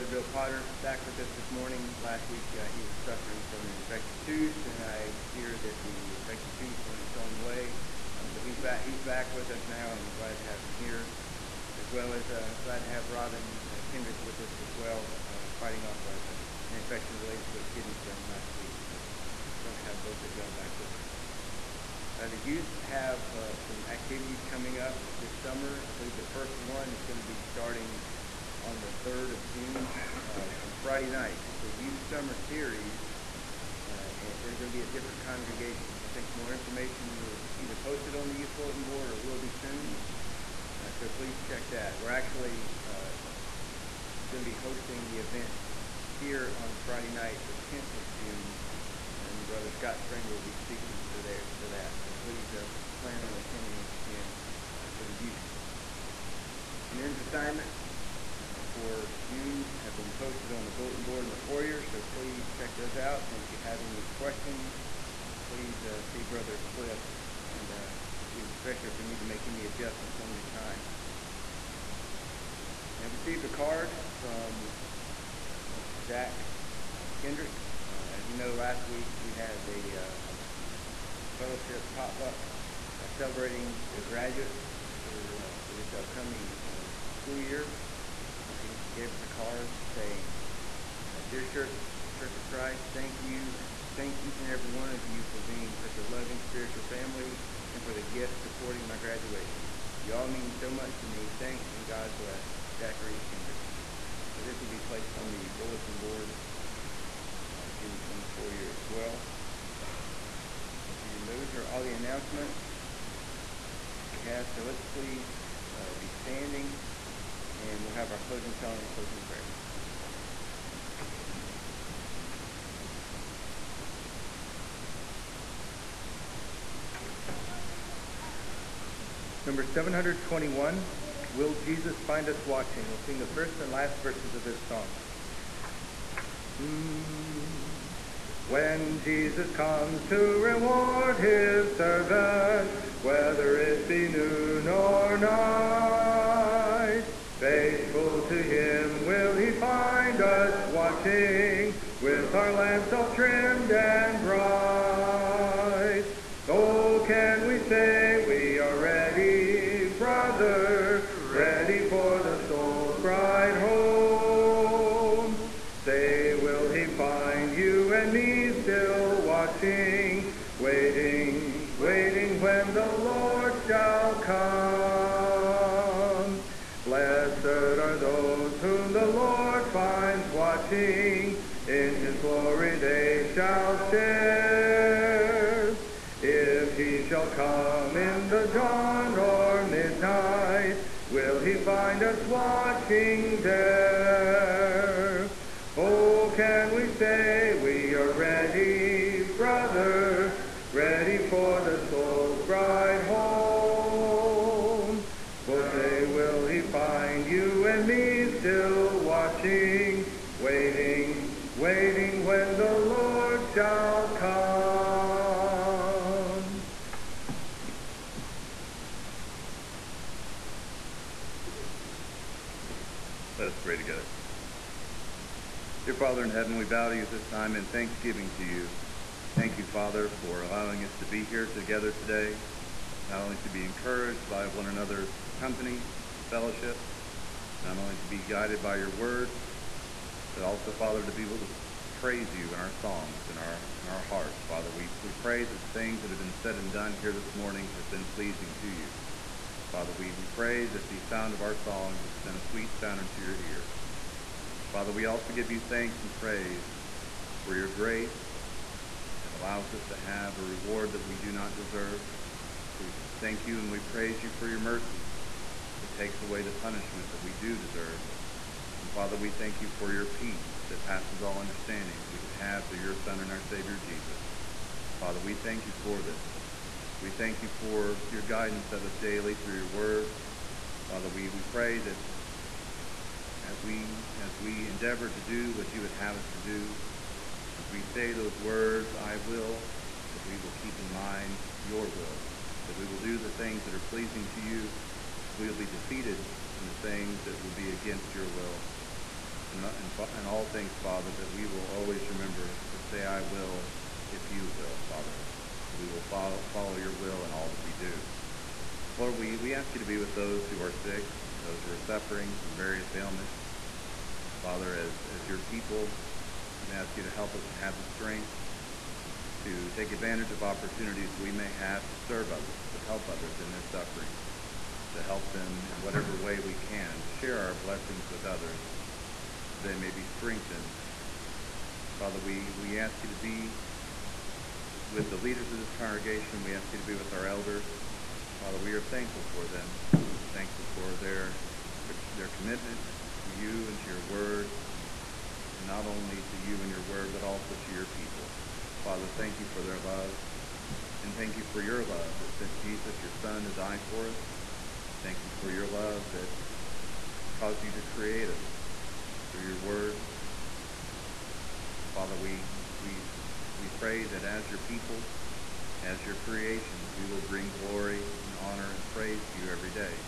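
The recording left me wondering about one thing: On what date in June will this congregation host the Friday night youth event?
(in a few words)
10th of June.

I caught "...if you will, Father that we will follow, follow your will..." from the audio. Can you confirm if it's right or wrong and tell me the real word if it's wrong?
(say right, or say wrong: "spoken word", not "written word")
right.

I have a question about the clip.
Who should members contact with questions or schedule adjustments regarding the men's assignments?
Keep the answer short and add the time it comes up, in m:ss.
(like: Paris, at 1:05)
Brother Cliff, at 1:06.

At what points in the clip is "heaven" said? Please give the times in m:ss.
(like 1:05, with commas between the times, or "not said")
3:46.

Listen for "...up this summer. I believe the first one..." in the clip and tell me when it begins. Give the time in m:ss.
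0:24.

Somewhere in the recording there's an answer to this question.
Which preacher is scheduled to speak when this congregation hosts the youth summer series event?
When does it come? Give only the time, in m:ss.
0:49.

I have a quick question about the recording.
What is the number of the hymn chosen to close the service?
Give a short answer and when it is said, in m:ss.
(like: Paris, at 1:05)
721, at 2:09.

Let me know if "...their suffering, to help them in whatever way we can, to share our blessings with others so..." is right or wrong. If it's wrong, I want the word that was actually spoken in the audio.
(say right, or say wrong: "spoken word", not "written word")
right.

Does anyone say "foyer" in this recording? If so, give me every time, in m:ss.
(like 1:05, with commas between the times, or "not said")
1:01, 1:48.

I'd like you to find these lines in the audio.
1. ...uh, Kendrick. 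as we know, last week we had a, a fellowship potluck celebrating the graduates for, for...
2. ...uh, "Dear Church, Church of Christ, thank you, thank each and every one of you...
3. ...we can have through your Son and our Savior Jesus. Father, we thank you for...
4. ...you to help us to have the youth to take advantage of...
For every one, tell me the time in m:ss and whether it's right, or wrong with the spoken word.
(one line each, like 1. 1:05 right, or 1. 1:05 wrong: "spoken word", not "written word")
1. 1:16 right
2. 1:31 right
3. 4:32 right
4. 5:16 wrong: "strength", not "youth".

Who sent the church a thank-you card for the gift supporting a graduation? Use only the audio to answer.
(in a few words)
Zachary Kendrick.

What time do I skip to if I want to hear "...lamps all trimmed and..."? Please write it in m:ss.
2:32.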